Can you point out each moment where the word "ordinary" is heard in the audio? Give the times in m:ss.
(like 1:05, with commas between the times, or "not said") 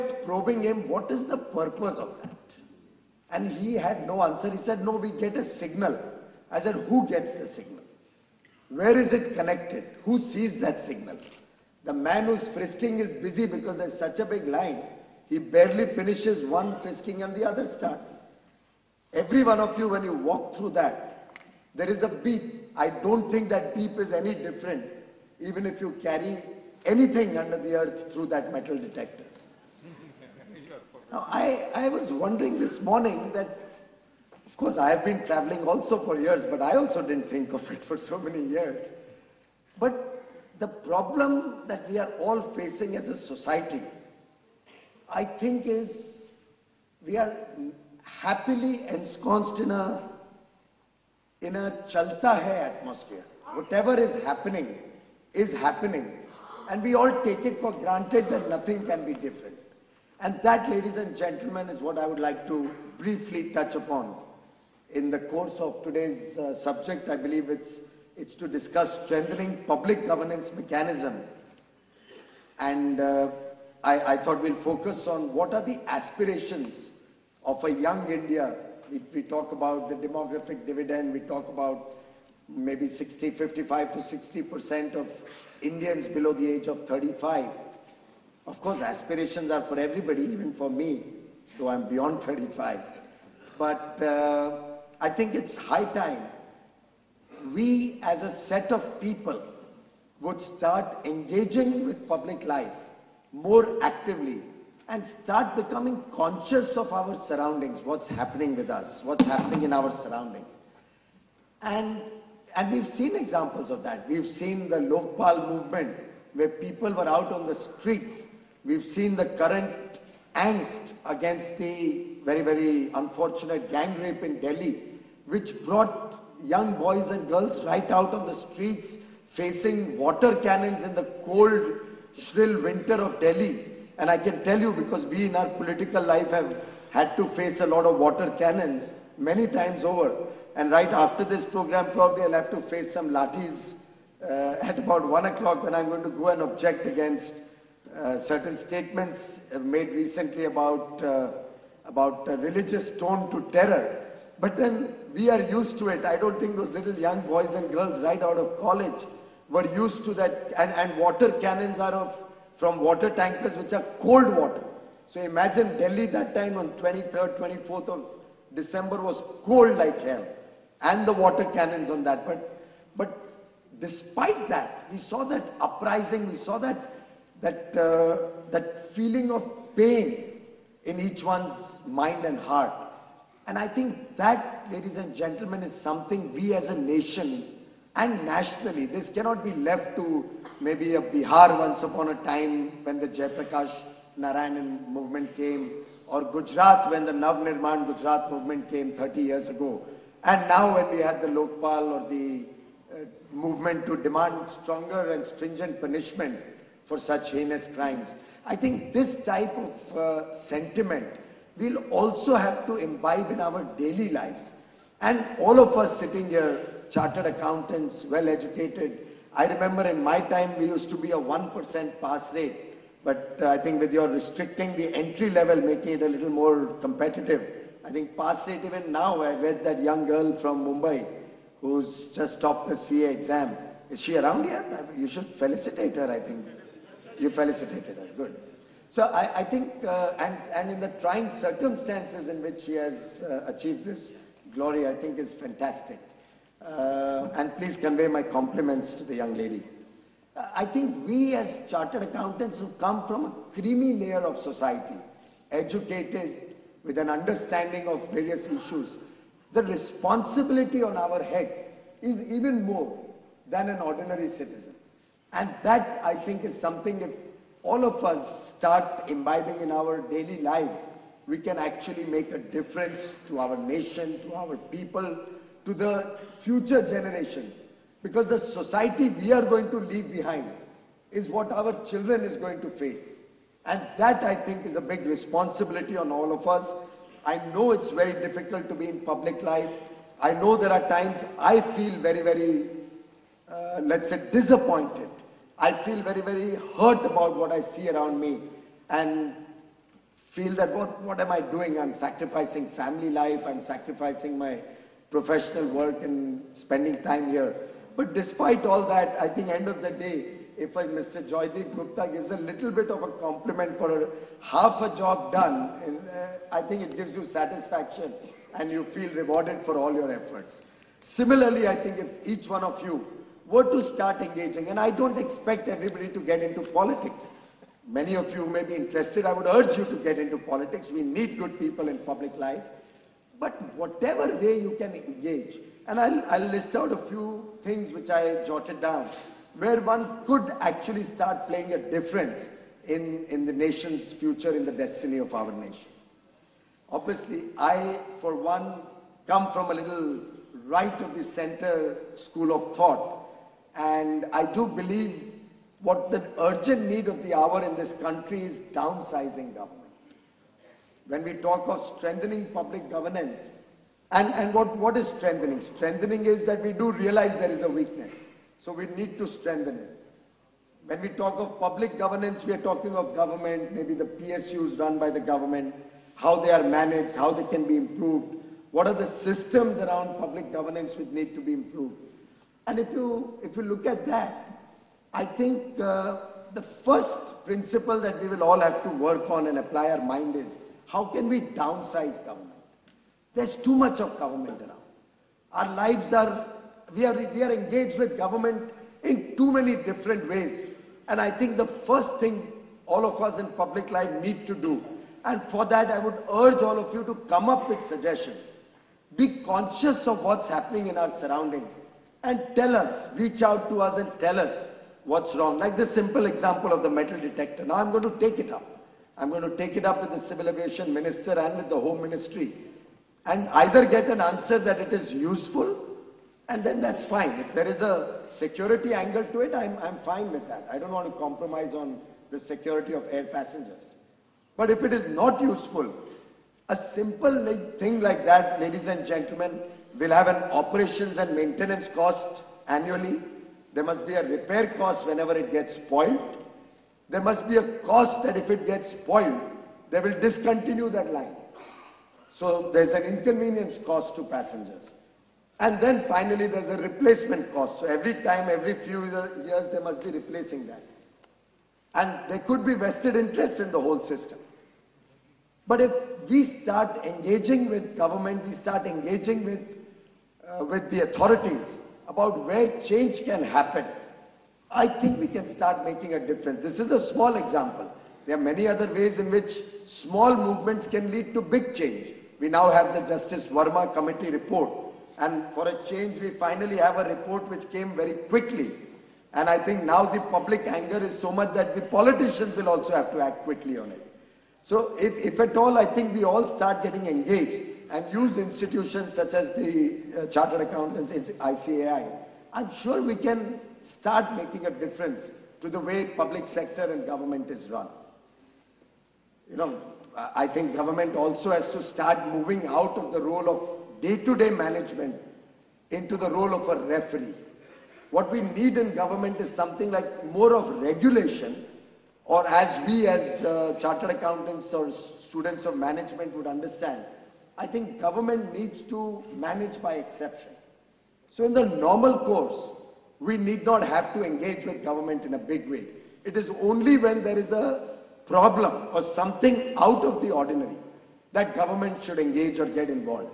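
4:23, 9:00.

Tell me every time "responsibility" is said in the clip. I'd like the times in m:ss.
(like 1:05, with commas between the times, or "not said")
4:19, 4:45.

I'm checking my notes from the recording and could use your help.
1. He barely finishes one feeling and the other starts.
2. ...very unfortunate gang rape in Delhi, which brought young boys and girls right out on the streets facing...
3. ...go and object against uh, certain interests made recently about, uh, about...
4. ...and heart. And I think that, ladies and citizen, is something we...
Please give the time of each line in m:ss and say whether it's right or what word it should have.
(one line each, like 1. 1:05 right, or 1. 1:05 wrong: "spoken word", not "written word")
1. 0:15 wrong: "frisking", not "feeling"
2. 2:02 right
3. 2:26 wrong: "statements", not "interests"
4. 3:02 wrong: "gentlemen", not "citizen".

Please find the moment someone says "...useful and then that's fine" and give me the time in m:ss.
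7:05.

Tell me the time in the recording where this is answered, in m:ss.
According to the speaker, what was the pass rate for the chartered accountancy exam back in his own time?
3:41.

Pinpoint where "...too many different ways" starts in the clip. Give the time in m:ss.
6:39.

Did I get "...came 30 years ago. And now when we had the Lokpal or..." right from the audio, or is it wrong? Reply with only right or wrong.
right.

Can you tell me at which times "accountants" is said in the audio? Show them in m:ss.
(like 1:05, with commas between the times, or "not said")
3:37, 4:12, 8:20, 8:44.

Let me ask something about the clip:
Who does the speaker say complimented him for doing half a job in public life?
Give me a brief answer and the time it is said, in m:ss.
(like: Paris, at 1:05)
Joydeep Gupta, at 5:10.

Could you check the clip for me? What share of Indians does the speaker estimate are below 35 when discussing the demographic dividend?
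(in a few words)
55 to 60%.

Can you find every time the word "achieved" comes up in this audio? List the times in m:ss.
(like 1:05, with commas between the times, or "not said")
4:03.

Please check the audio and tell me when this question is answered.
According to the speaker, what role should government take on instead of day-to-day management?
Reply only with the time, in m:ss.
8:36.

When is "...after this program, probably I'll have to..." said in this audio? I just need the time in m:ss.
2:20.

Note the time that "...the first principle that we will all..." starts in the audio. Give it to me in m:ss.
6:26.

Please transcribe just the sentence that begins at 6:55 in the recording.
Like the simple example of the metal detector.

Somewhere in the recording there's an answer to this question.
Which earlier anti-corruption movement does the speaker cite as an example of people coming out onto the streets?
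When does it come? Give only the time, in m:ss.
1:54.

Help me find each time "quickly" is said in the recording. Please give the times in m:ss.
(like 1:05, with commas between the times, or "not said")
8:08, 8:13.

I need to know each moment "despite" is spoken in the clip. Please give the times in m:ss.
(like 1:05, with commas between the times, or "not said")
2:53, 5:08.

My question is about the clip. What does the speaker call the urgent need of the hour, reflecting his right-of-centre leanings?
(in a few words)
downsizing government.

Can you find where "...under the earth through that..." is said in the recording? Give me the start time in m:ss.
0:27.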